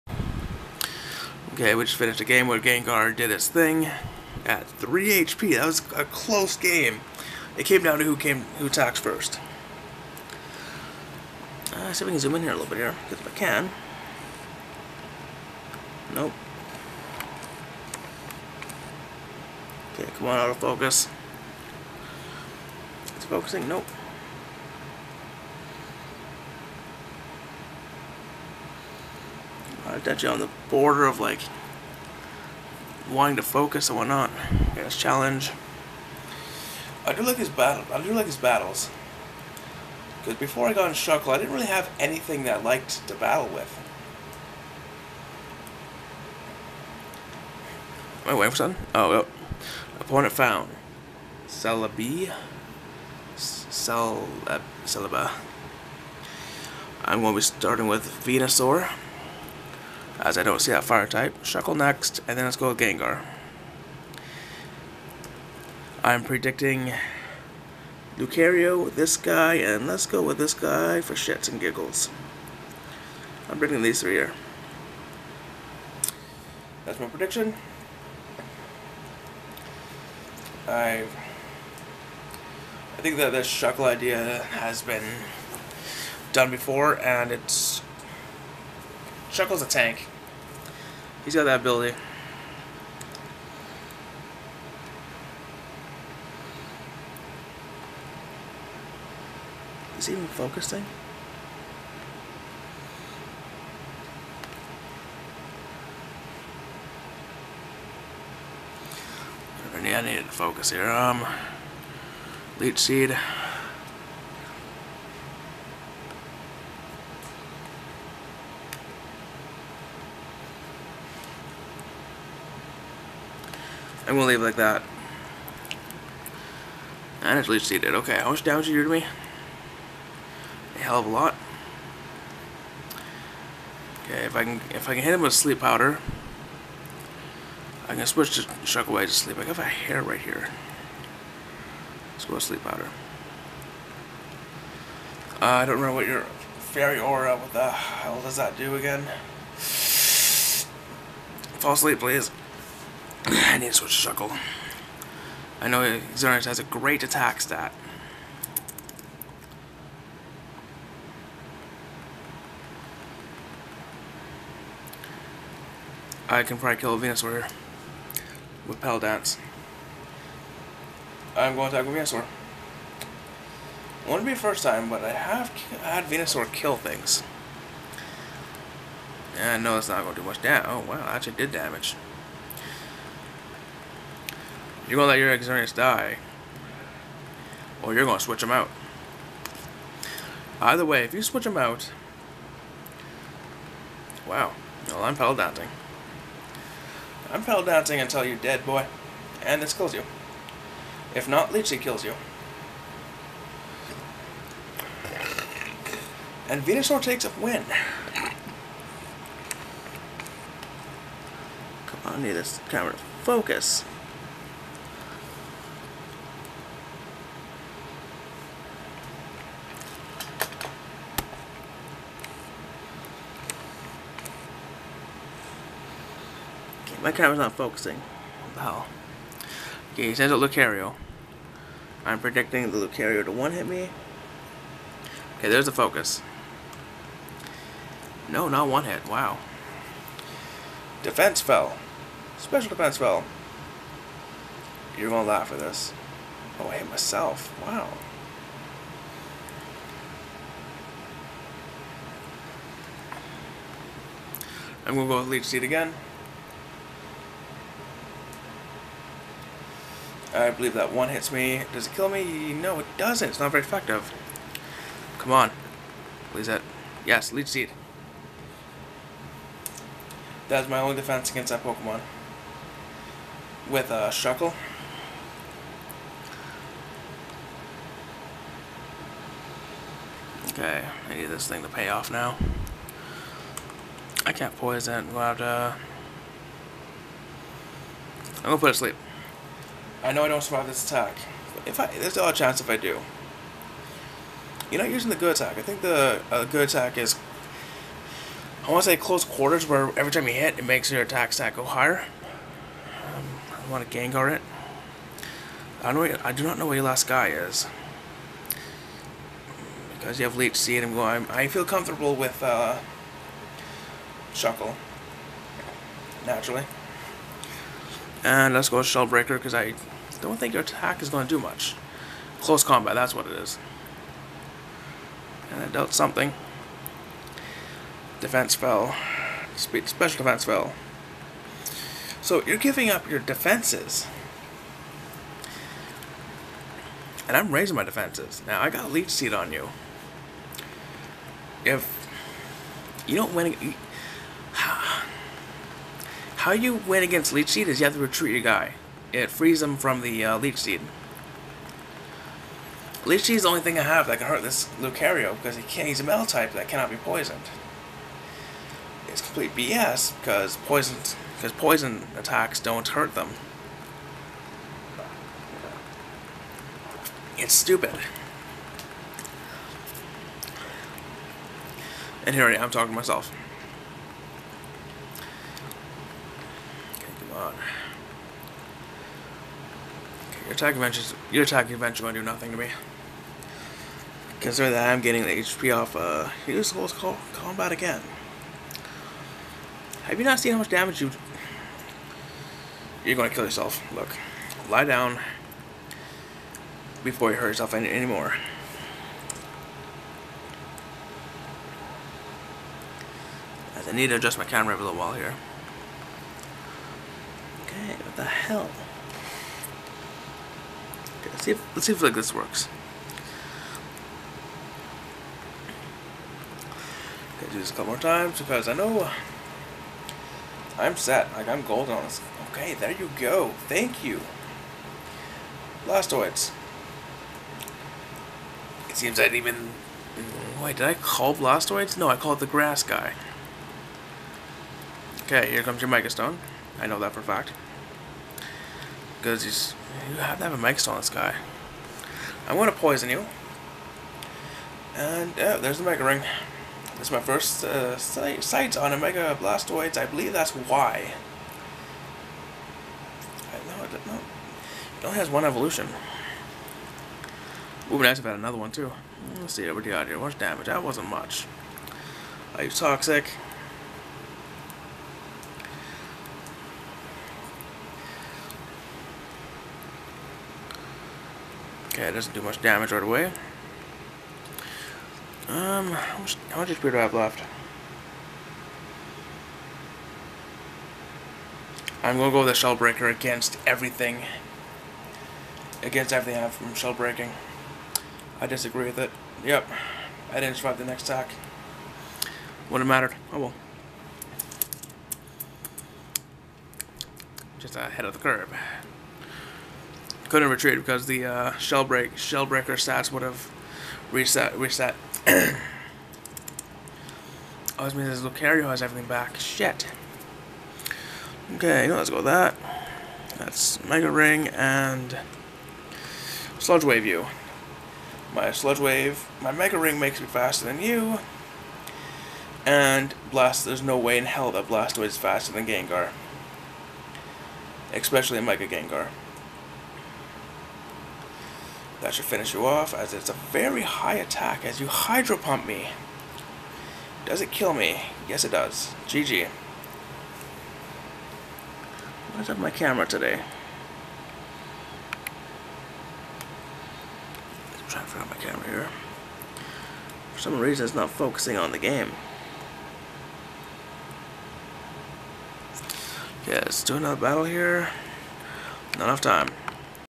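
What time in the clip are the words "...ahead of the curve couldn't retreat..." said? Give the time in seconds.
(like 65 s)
497 s.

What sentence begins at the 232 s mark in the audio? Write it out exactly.
I'm predicting the Lucario to one hit me.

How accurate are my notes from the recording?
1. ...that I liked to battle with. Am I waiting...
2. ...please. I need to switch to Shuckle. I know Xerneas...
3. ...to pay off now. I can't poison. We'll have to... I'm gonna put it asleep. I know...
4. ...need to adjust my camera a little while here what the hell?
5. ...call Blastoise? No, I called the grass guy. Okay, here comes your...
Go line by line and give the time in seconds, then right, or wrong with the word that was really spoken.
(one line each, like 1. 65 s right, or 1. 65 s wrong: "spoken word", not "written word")
1. 42 s right
2. 151 s right
3. 281 s right
4. 403 s right
5. 430 s right.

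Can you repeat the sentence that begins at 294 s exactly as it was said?
You're not using the good attack.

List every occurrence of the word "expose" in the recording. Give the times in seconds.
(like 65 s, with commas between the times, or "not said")
not said.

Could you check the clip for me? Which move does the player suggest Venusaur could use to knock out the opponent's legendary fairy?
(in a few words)
Petal Dance.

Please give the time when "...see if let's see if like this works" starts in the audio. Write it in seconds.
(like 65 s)
411 s.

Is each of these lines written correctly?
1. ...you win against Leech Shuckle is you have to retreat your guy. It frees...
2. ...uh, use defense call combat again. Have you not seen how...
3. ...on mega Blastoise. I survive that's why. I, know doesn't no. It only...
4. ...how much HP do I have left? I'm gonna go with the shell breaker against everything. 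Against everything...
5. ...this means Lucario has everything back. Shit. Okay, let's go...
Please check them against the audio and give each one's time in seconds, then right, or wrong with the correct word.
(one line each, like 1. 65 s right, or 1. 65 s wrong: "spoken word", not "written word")
1. 346 s wrong: "Seed", not "Shuckle"
2. 385 s wrong: "close", not "defense"
3. 448 s wrong: "believe", not "survive"
4. 476 s right
5. 507 s right.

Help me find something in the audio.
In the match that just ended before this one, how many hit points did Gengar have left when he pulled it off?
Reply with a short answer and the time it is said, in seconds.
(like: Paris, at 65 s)
3 HP, at 4 s.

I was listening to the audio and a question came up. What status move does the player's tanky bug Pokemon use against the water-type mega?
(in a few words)
Toxic.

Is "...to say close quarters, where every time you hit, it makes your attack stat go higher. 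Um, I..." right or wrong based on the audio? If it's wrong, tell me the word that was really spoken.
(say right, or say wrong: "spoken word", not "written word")
right.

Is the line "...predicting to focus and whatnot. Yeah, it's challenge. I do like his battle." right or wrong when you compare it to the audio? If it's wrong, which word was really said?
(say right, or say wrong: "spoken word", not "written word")
wrong: "wanting", not "predicting".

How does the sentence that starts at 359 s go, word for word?
It's complete BS because poison, because poison attacks don't hurt them.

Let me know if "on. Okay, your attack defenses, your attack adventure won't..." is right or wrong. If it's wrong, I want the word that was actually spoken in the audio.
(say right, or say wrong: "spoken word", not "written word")
wrong: "adventures", not "defenses".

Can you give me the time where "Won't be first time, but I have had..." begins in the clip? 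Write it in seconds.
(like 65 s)
174 s.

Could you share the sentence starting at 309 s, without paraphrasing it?
Because you have Leech Seed, I'm going, I feel comfortable with uh, Shuckle.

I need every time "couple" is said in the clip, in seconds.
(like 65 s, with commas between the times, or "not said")
417 s.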